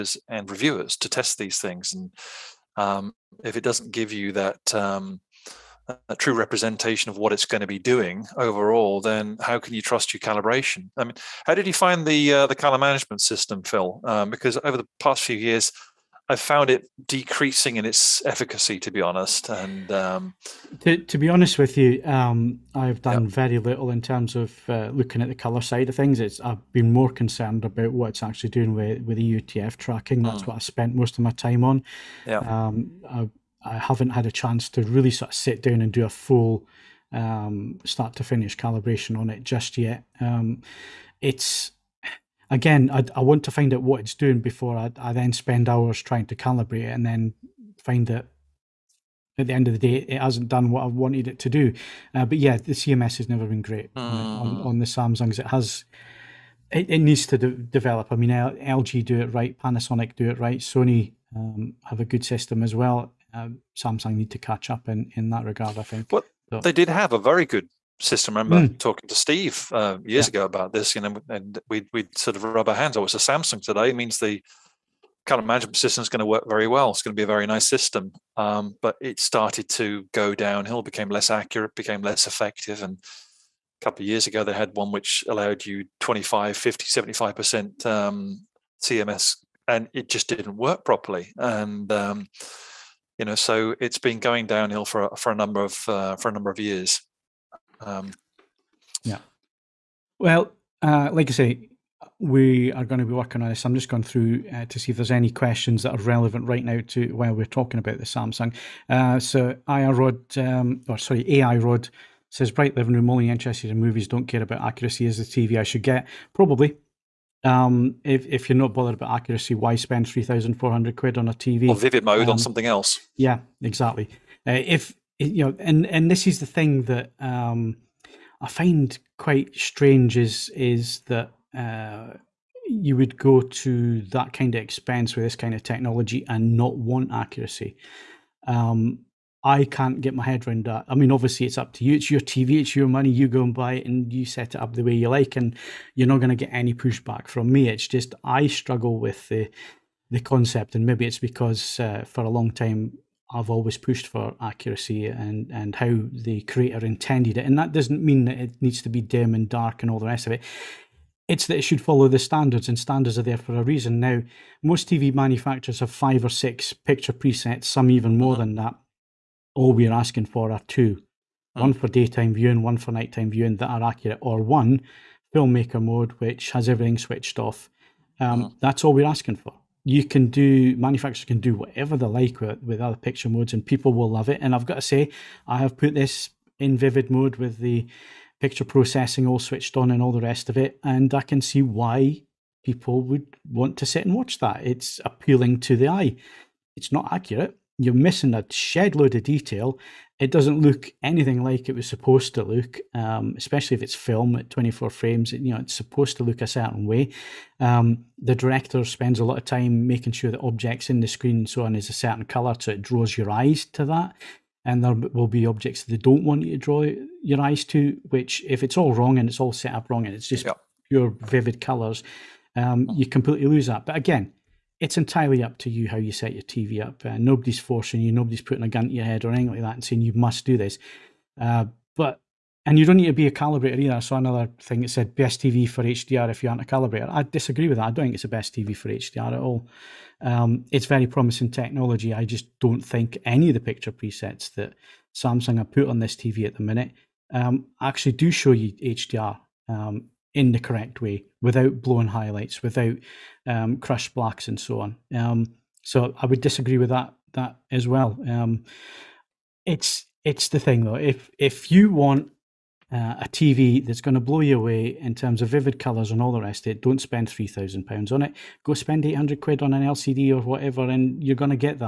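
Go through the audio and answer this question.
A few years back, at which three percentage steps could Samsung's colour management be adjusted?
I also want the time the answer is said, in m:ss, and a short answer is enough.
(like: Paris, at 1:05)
25, 50, 75%, at 1:25.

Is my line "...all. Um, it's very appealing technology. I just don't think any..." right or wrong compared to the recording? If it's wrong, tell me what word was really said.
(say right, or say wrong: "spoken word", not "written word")
wrong: "promising", not "appealing".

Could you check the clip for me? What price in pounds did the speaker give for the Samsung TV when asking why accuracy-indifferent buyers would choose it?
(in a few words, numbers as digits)
£3,400.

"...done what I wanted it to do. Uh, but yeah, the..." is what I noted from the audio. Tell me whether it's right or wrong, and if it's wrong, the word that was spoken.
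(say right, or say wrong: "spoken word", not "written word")
right.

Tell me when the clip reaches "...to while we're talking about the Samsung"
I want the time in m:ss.
1:46.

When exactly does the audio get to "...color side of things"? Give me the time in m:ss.
0:25.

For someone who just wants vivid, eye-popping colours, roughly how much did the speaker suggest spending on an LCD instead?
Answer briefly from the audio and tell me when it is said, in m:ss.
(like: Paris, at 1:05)
£800, at 4:29.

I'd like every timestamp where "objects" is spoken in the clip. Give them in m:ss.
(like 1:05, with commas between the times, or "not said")
3:30, 3:35.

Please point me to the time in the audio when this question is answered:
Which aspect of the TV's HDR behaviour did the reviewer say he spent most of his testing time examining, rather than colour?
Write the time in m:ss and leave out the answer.
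0:29.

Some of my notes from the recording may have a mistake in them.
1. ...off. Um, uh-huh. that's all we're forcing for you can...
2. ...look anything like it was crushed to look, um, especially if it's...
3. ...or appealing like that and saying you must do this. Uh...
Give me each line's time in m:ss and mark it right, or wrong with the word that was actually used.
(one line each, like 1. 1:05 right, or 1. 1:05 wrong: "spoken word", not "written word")
1. 2:57 wrong: "asking", not "forcing"
2. 3:20 wrong: "supposed", not "crushed"
3. 3:49 wrong: "anything", not "appealing".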